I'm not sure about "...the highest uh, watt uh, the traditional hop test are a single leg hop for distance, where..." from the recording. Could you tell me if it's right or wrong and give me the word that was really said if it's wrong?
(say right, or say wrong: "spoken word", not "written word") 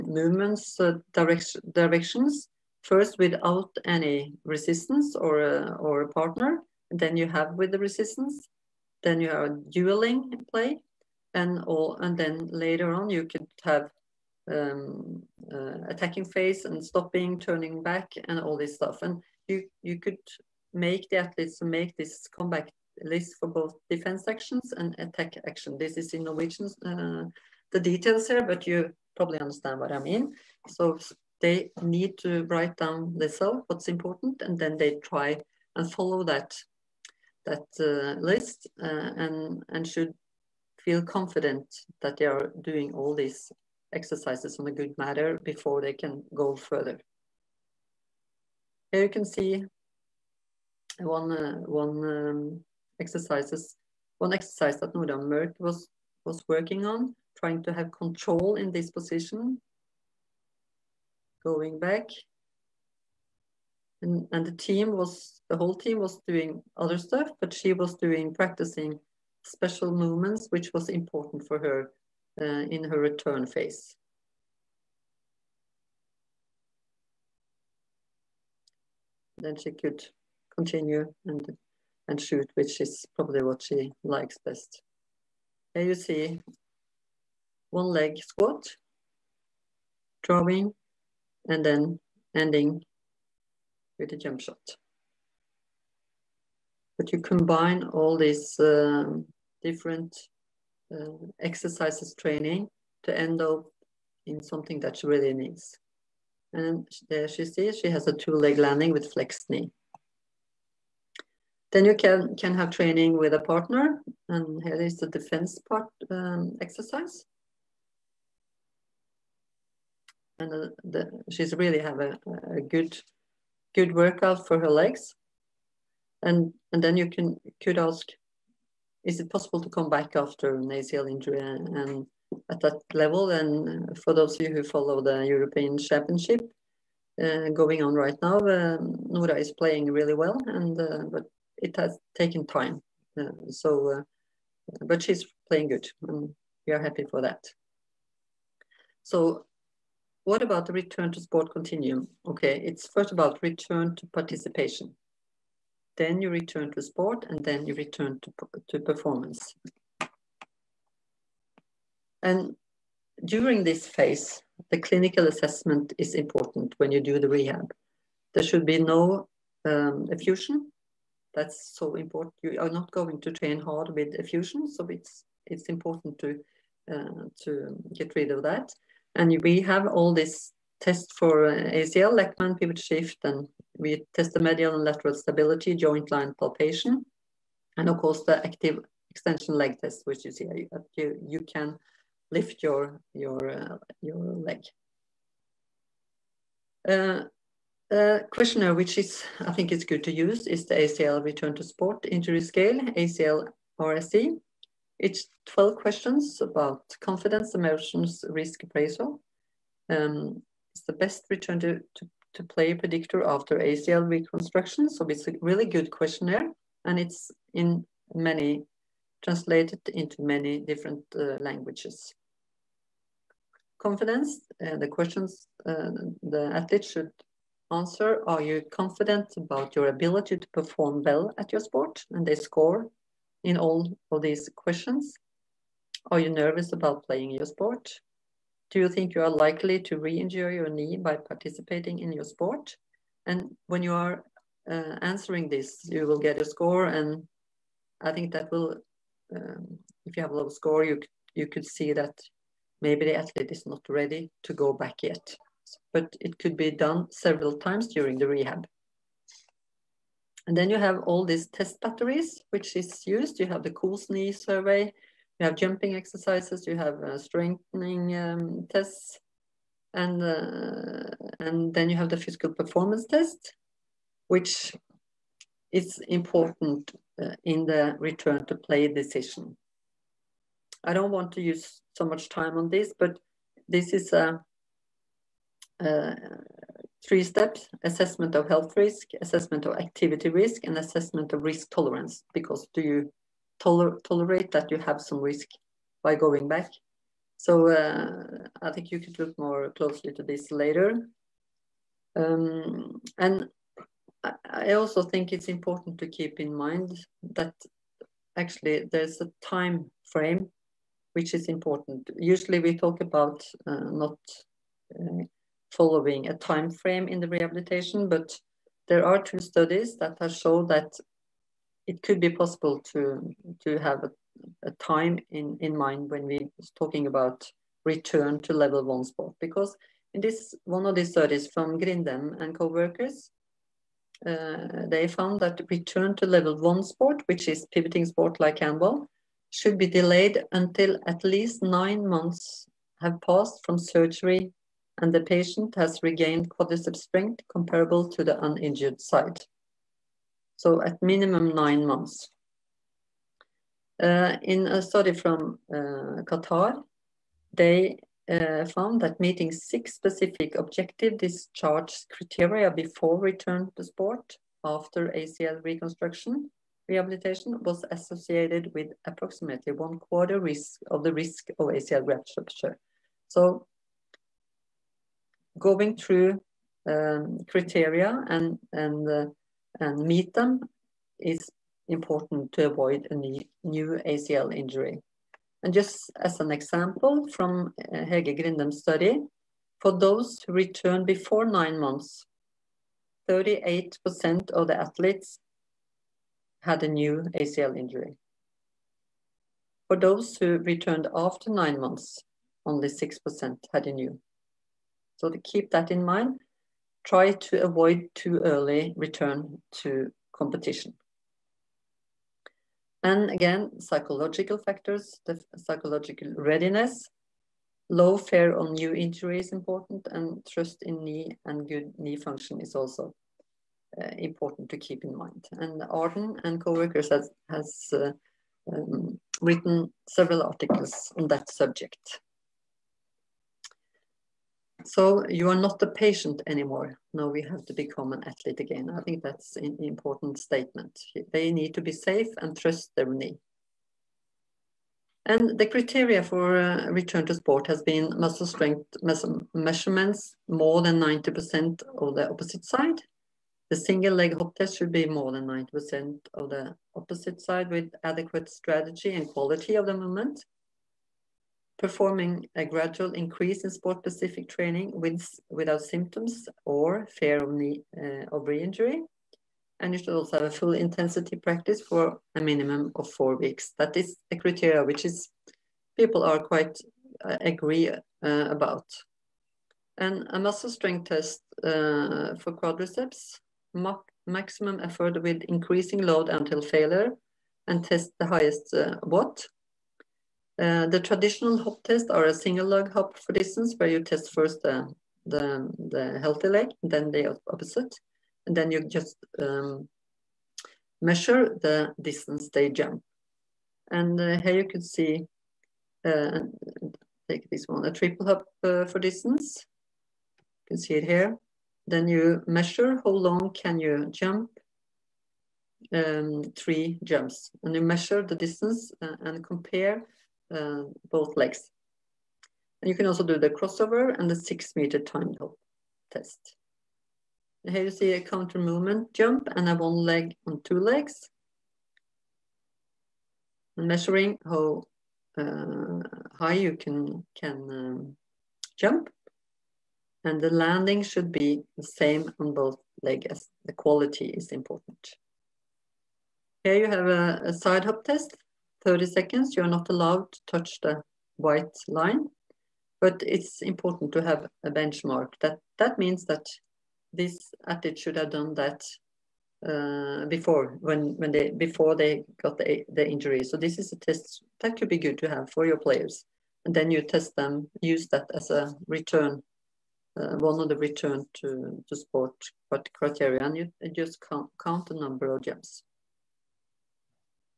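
right.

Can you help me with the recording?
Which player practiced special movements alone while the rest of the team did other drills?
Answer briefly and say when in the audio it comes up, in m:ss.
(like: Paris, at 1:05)
Nora Mørk, at 0:54.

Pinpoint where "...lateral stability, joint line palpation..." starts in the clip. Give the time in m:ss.
3:04.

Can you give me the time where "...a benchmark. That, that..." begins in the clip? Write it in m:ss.
9:14.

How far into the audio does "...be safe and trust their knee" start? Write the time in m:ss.
7:21.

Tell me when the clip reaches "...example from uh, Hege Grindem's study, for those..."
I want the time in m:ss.
6:26.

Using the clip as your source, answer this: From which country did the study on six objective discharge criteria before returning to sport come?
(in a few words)
Qatar.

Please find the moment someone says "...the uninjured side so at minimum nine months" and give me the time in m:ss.
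5:48.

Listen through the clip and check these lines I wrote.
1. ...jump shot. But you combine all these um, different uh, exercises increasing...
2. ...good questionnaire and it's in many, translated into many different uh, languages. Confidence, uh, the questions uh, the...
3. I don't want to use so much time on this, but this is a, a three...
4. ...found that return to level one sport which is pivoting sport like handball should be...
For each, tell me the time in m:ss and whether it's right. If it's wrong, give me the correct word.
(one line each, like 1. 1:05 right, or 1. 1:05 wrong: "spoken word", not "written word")
1. 1:34 wrong: "training", not "increasing"
2. 3:35 right
3. 4:40 right
4. 5:35 right.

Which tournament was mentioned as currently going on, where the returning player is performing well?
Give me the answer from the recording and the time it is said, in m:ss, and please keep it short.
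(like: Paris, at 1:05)
European Championship, at 2:15.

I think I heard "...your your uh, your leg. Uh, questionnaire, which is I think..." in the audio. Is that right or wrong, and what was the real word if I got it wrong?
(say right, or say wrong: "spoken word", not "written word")
right.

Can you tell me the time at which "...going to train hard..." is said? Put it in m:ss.
2:52.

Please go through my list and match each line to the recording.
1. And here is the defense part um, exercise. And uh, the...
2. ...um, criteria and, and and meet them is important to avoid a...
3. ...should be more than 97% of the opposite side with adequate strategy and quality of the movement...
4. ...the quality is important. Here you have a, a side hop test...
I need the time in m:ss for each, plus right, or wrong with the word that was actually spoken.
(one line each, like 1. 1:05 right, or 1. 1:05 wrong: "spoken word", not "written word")
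1. 1:54 right
2. 6:16 right
3. 7:34 wrong: "90", not "97"
4. 9:03 right.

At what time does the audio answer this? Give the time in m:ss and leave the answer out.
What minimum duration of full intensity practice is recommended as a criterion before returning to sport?
7:53.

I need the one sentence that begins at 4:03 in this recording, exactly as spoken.
And when you are uh, answering this, you will get a score.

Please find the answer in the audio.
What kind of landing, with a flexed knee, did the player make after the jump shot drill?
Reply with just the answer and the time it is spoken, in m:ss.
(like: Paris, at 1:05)
two-leg landing, at 1:48.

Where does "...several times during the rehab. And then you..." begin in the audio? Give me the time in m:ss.
4:17.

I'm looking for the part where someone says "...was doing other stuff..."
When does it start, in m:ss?
1:05.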